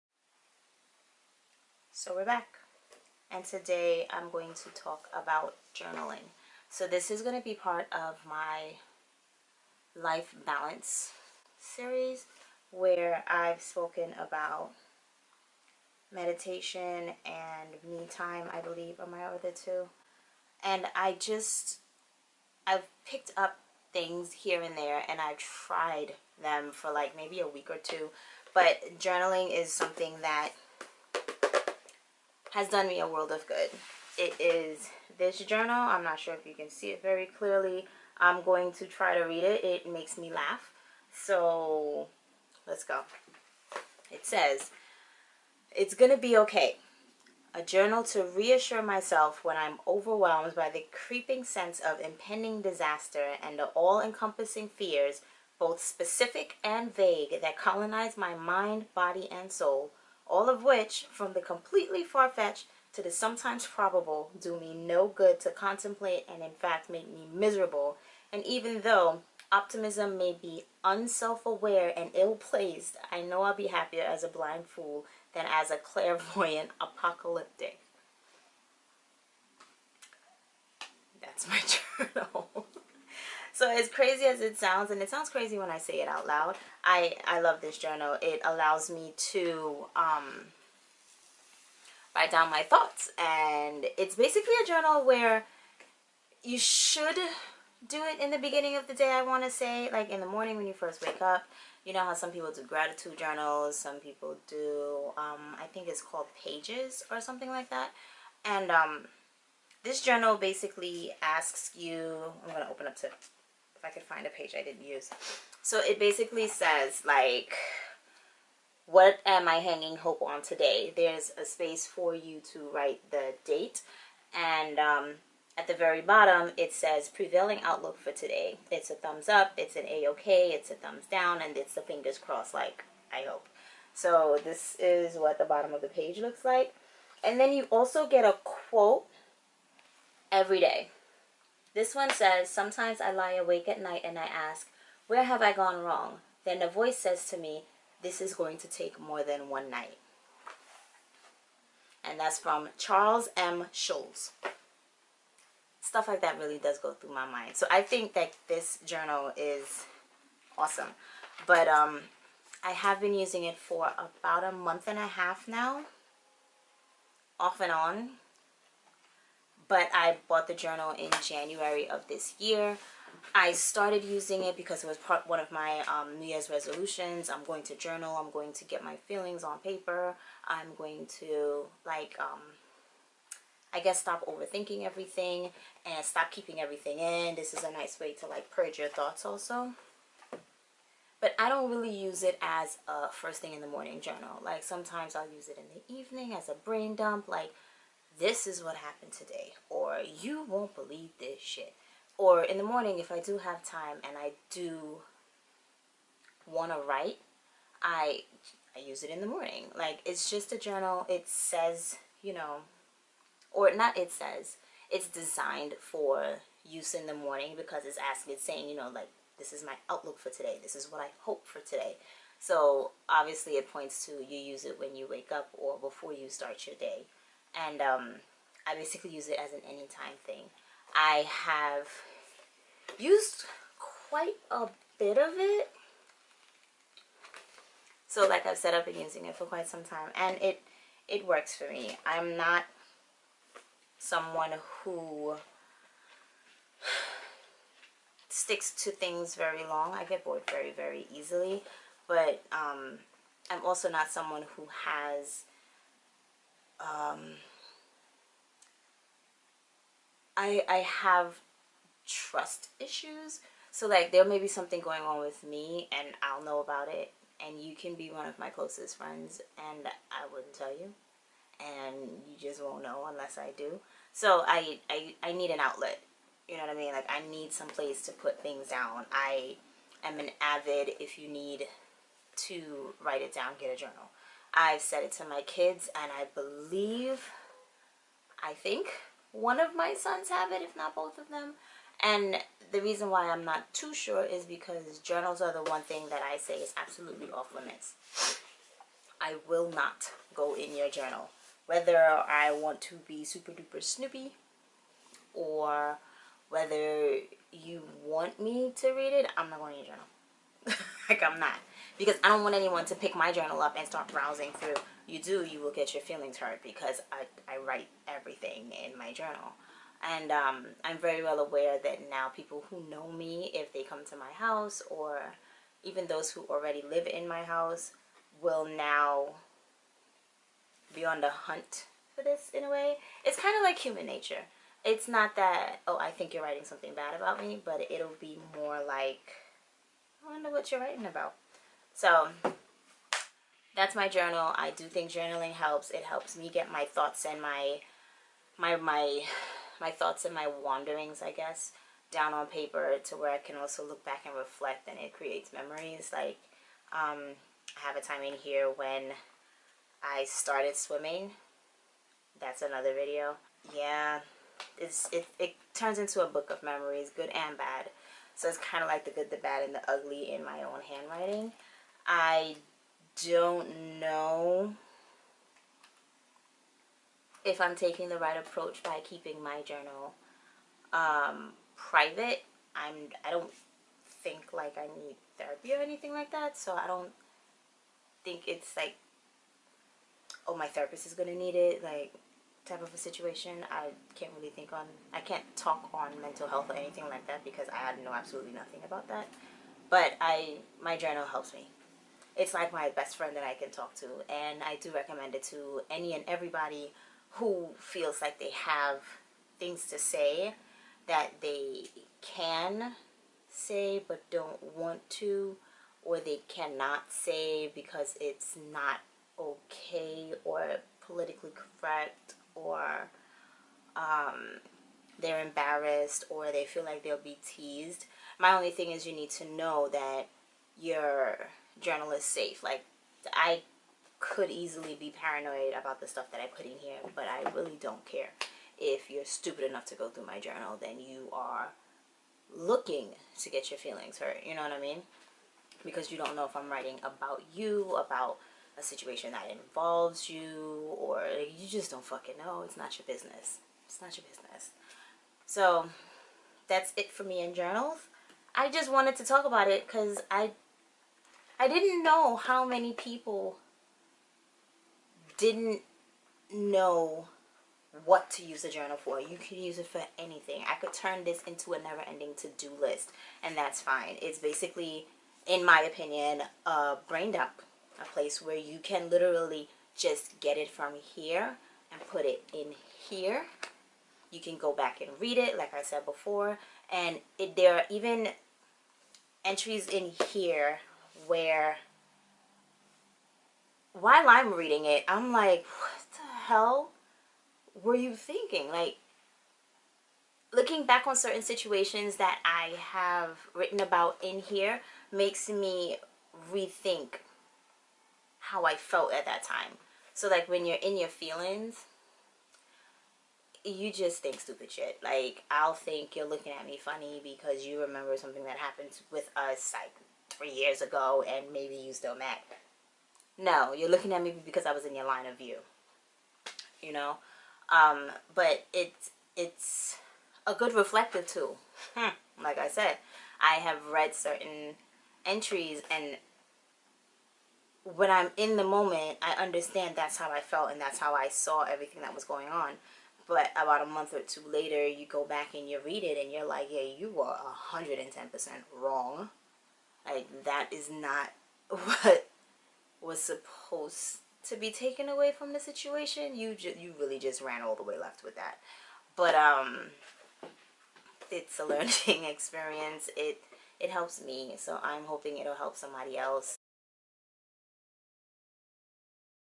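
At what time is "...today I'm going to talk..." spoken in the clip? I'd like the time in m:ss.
0:03.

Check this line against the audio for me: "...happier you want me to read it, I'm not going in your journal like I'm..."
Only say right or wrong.
wrong.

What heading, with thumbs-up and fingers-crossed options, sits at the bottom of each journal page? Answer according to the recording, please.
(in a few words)
prevailing outlook for today.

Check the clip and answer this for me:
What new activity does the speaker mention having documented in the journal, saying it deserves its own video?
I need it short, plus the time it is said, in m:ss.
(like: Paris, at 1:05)
swimming, at 6:00.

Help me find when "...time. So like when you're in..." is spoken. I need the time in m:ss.
8:29.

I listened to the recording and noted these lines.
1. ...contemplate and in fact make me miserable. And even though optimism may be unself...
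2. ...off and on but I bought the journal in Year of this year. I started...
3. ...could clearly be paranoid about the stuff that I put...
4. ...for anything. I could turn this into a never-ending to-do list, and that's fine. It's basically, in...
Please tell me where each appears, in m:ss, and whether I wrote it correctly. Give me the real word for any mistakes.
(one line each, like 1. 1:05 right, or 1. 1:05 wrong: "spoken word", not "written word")
1. 1:05 right
2. 2:47 wrong: "January", not "Year"
3. 7:14 wrong: "easily", not "clearly"
4. 7:49 right.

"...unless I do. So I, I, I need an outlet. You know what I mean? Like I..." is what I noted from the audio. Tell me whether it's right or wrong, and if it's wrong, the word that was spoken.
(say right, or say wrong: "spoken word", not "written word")
right.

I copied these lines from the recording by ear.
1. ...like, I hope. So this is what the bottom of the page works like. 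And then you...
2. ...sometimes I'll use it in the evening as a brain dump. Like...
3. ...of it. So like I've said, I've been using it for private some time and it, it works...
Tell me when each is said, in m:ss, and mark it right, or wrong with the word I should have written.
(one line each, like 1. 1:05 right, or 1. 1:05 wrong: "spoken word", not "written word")
1. 2:12 wrong: "looks", not "works"
2. 3:14 right
3. 3:55 wrong: "quite", not "private".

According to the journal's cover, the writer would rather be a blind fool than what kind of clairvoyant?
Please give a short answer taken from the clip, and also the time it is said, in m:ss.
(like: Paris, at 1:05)
apocalyptic, at 1:16.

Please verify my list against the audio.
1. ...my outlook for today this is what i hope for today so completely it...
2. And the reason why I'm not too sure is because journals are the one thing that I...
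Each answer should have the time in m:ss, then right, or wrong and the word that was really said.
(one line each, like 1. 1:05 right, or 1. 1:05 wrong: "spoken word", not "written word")
1. 3:39 wrong: "obviously", not "completely"
2. 4:52 right.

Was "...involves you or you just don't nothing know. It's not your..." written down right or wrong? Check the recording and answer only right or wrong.
wrong.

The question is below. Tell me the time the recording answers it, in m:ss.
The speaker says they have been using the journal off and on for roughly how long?
2:43.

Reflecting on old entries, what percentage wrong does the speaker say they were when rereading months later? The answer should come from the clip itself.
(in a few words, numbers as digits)
110%.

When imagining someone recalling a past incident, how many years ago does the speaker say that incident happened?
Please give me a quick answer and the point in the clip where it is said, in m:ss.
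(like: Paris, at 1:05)
3, at 8:40.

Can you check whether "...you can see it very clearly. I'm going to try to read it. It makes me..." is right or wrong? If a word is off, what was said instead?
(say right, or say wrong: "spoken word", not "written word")
right.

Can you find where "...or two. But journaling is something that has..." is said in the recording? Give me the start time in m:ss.
0:27.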